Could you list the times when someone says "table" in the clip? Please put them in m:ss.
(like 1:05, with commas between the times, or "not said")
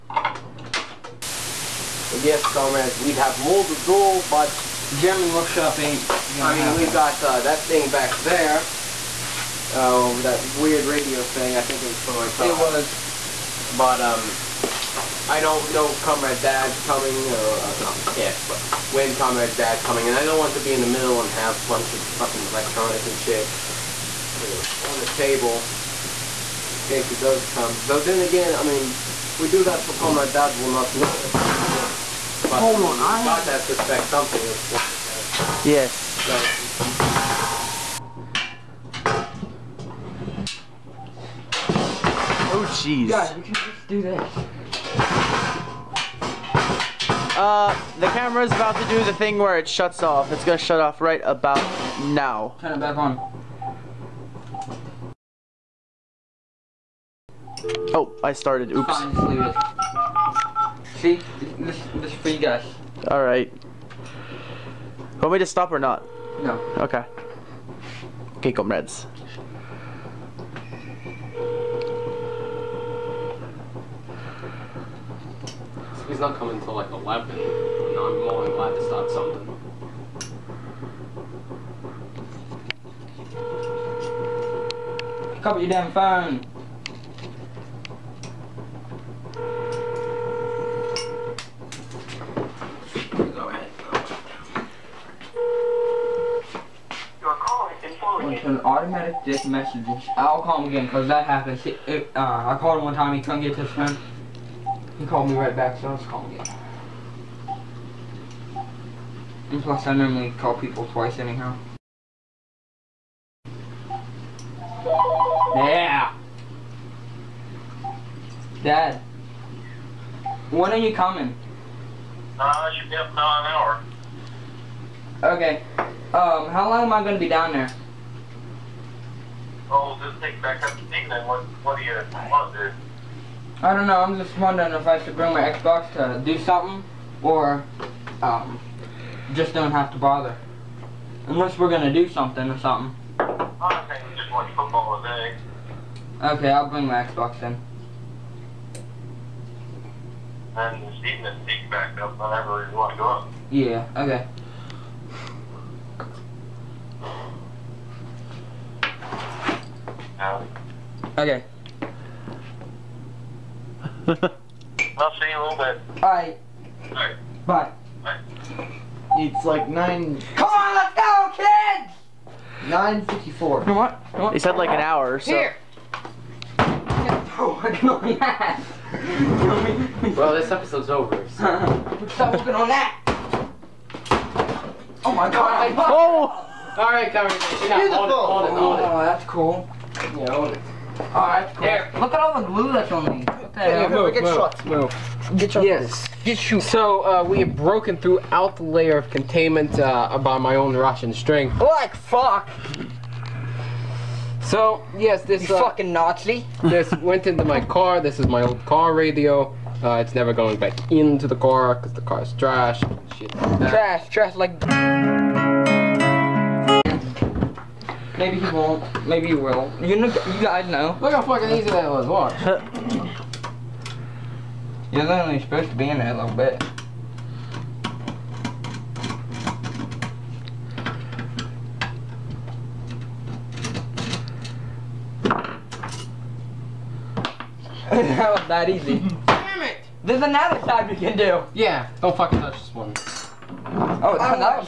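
0:25.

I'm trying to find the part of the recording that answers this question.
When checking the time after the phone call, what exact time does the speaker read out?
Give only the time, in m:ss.
2:52.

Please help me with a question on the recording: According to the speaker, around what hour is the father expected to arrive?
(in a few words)
11.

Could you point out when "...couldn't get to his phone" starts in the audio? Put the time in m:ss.
1:43.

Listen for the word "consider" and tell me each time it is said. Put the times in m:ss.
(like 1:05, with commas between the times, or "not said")
not said.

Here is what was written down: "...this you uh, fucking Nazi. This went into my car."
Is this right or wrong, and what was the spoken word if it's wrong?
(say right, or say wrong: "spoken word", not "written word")
right.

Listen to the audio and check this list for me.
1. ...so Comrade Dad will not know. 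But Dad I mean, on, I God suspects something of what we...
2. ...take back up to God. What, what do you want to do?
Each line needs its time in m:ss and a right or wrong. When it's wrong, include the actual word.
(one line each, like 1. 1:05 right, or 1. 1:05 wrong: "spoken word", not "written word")
1. 0:29 wrong: "Hold", not "Dad"
2. 2:10 wrong: "England", not "God".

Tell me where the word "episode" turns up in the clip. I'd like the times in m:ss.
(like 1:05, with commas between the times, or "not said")
3:00.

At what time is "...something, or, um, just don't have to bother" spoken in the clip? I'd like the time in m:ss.
2:16.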